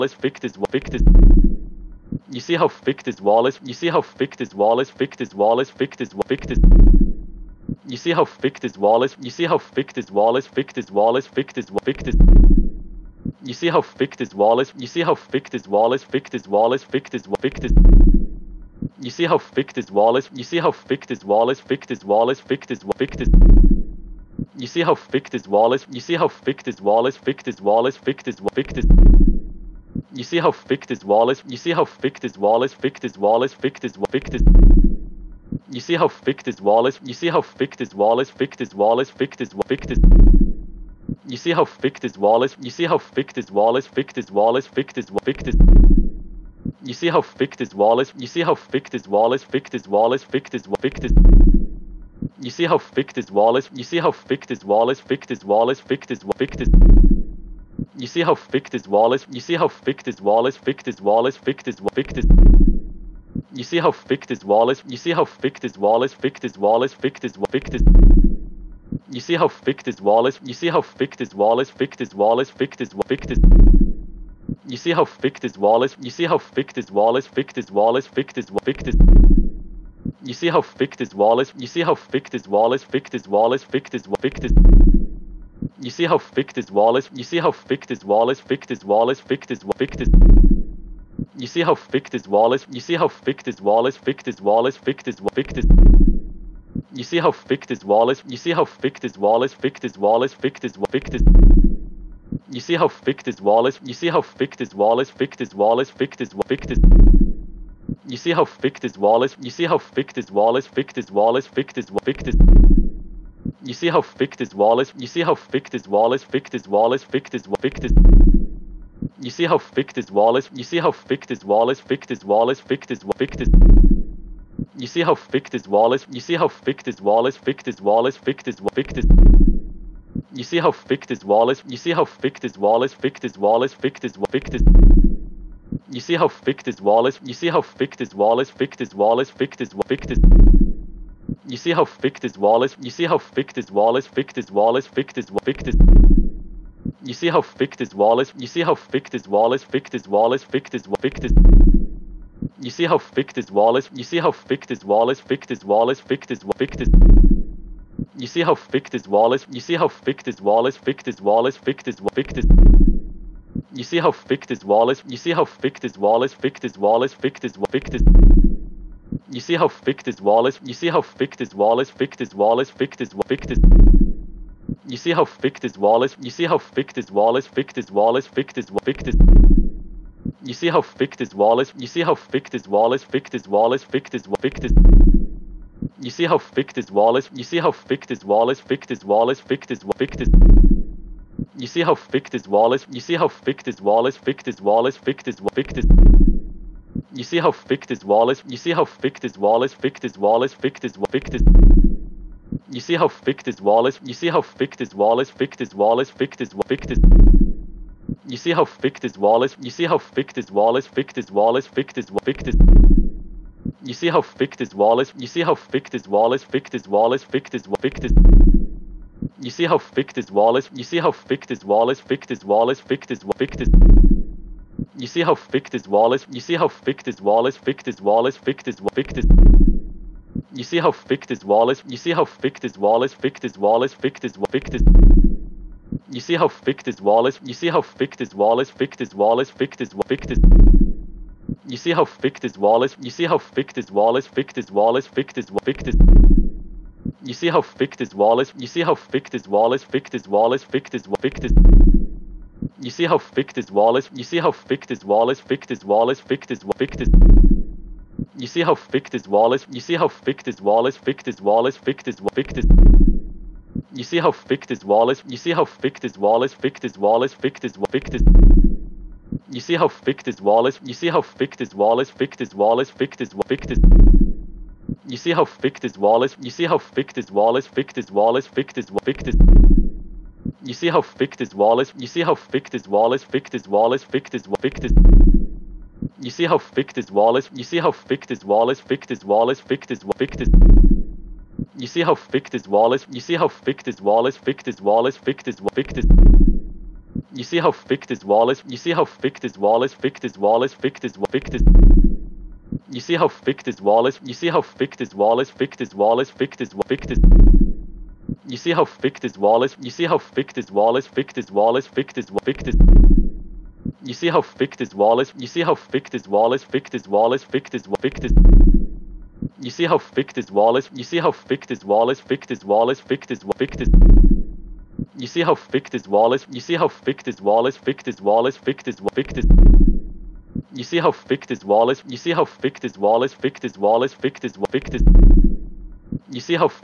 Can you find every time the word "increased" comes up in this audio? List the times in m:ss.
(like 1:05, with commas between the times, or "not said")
not said.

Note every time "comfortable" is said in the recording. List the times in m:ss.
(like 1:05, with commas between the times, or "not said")
not said.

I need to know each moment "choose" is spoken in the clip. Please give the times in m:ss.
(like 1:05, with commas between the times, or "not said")
not said.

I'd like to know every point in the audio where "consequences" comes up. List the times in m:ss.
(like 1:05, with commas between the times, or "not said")
not said.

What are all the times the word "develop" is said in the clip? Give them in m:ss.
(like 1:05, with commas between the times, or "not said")
not said.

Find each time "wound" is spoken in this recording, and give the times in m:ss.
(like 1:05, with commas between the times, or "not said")
not said.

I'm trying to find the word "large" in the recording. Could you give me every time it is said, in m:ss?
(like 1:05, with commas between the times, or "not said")
not said.